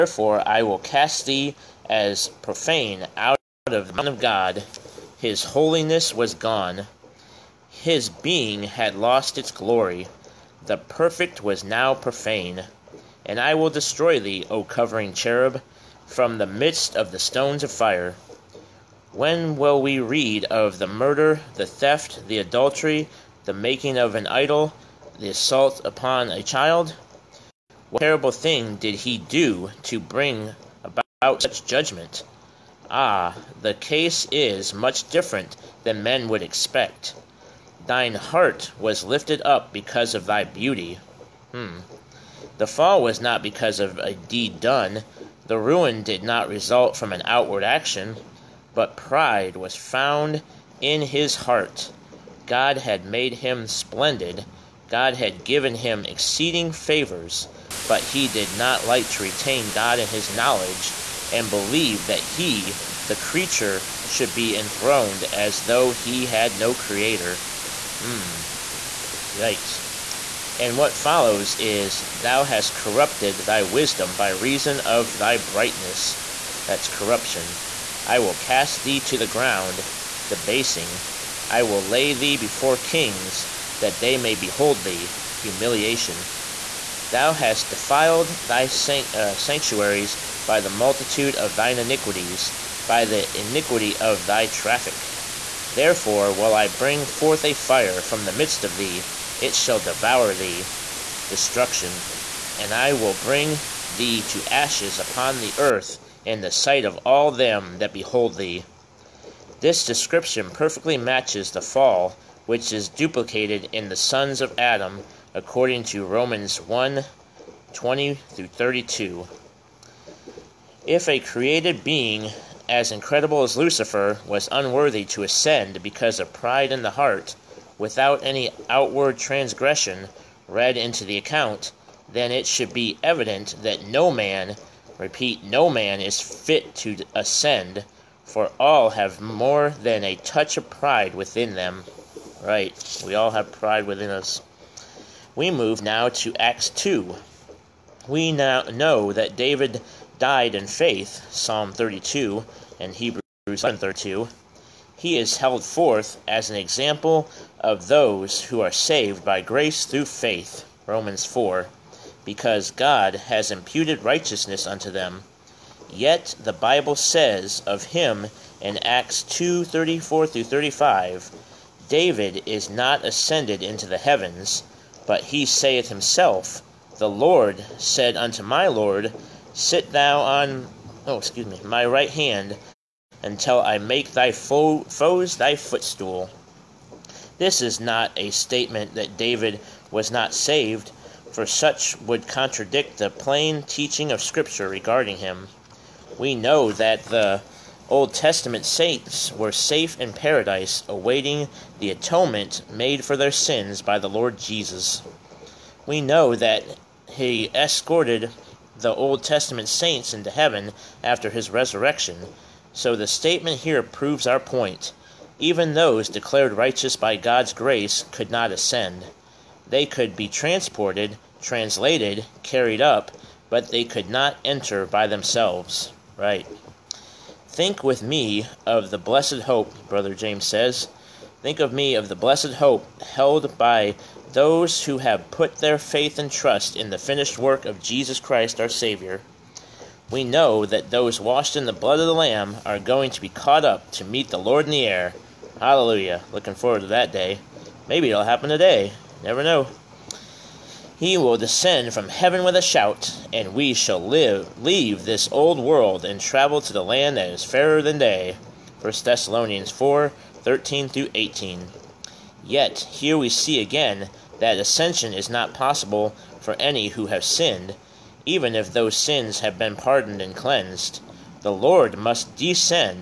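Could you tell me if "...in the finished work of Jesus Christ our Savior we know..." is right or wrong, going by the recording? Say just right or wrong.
right.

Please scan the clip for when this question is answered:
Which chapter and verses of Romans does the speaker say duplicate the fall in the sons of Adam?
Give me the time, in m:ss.
1:56.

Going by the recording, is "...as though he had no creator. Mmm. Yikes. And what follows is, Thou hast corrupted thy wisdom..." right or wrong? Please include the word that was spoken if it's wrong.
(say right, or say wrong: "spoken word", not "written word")
right.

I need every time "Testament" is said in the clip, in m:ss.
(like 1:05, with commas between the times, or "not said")
3:18, 3:29.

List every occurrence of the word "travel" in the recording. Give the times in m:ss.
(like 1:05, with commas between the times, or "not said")
4:16.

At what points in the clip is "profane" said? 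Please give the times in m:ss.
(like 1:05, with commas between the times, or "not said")
0:02, 0:11.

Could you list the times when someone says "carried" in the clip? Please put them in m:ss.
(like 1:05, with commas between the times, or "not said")
3:42.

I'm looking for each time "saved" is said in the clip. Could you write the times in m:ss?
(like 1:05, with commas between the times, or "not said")
2:38, 3:10.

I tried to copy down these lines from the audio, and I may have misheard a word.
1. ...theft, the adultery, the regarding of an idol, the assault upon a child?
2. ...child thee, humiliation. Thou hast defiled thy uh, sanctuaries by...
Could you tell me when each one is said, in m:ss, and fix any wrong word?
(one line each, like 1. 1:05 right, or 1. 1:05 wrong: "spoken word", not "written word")
1. 0:21 wrong: "making", not "regarding"
2. 1:24 wrong: "behold", not "child".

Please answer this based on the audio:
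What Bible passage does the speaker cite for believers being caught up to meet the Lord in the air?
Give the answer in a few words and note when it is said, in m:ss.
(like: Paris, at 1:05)
1 Thessalonians 4:13-18, at 4:18.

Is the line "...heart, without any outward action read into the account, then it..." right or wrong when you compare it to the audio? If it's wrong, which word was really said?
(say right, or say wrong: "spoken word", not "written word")
wrong: "transgression", not "action".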